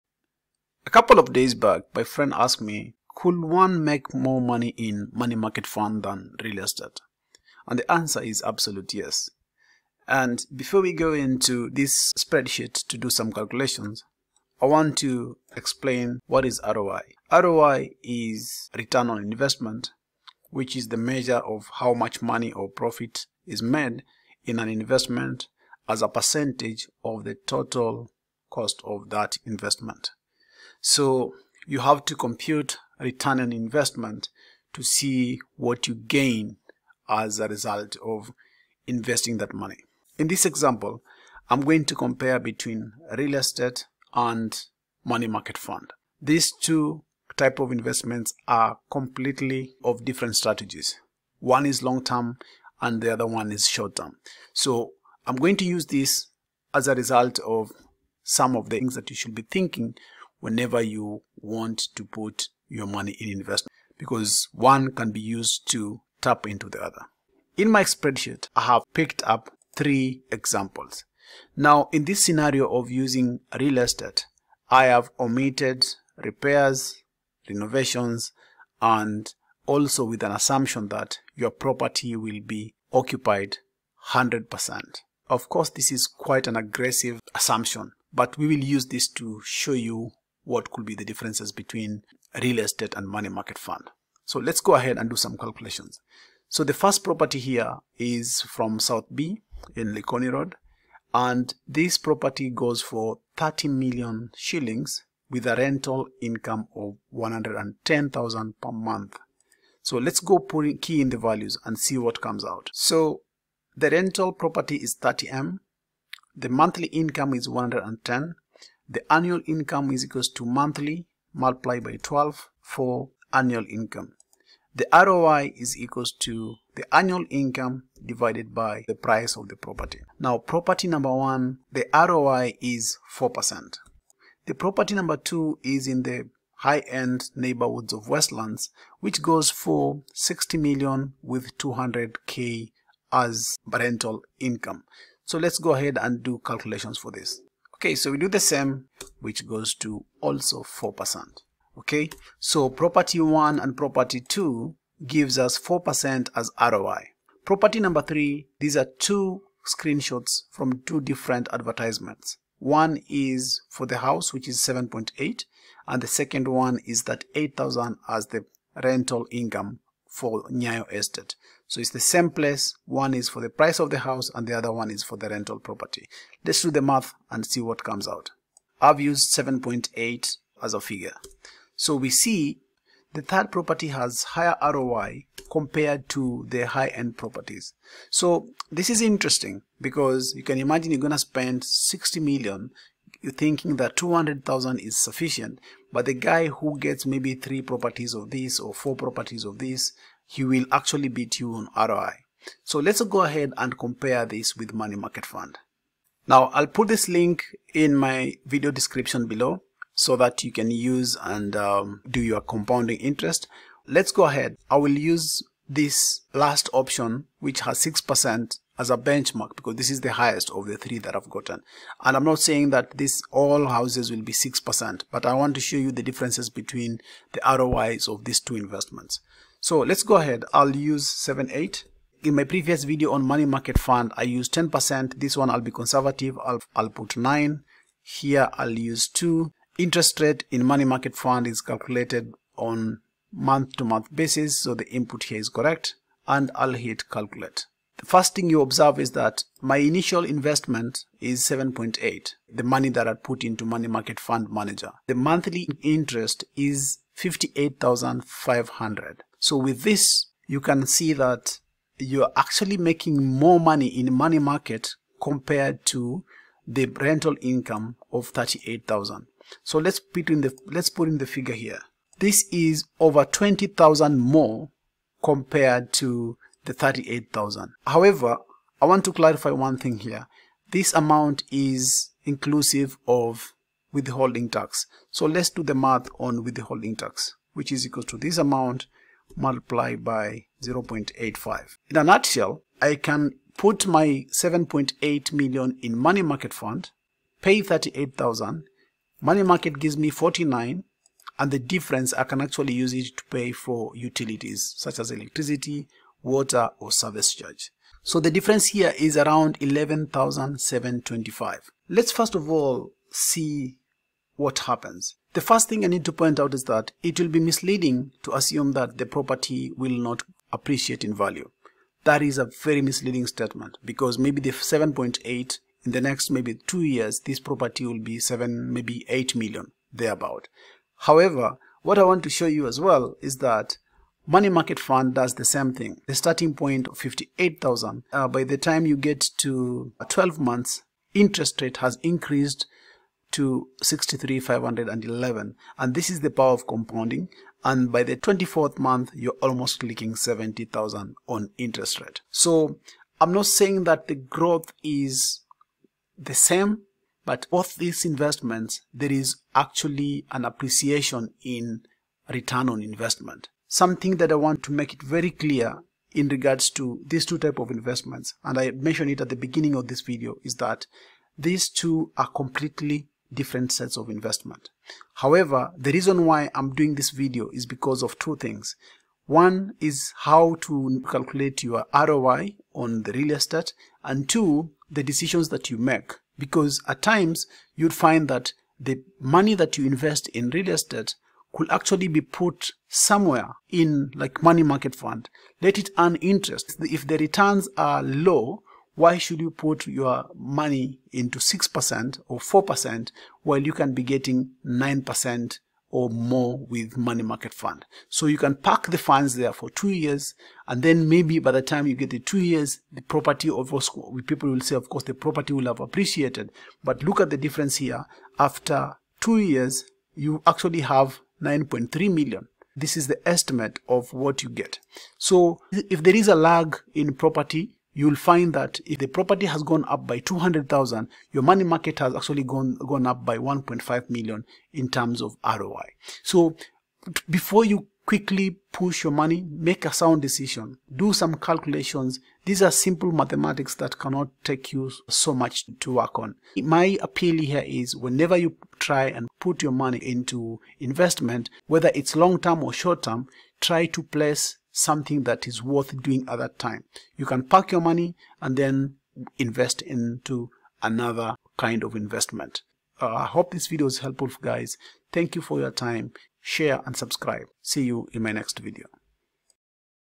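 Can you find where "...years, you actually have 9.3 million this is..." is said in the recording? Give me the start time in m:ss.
6:59.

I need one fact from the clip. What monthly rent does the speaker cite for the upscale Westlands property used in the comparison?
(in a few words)
200k.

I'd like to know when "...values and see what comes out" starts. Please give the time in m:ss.
1:51.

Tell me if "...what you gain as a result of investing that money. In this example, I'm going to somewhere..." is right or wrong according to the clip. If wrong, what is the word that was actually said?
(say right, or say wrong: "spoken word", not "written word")
wrong: "compare", not "somewhere".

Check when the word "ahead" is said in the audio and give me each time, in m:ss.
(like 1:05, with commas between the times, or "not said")
1:34, 2:25, 3:23, 3:34, 3:50.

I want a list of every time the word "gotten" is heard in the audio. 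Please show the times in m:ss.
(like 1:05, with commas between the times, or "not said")
3:41.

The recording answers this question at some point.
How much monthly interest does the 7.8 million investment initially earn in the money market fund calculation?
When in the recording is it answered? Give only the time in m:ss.
4:17.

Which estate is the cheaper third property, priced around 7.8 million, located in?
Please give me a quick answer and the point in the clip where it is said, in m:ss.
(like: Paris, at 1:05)
Nyayo Estate, at 2:50.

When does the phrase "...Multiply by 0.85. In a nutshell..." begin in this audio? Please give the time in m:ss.
4:49.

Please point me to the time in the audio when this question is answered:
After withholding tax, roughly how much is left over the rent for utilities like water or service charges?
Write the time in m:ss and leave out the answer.
5:09.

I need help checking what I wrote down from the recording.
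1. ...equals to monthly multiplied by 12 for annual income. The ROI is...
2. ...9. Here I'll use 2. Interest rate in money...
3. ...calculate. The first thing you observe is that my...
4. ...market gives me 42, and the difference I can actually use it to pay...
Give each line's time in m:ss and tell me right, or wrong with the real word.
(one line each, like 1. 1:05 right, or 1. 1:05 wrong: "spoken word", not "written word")
1. 2:00 right
2. 3:57 right
3. 4:07 right
4. 4:59 wrong: "49", not "42".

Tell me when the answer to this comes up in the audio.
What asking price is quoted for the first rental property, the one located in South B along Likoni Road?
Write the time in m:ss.
1:43.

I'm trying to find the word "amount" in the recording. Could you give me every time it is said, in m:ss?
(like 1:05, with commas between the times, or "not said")
4:40, 4:48.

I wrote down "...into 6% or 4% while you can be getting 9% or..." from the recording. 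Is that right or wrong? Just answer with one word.
right.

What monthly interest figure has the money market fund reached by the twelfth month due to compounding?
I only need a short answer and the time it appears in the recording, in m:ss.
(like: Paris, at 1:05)
63,511, at 5:43.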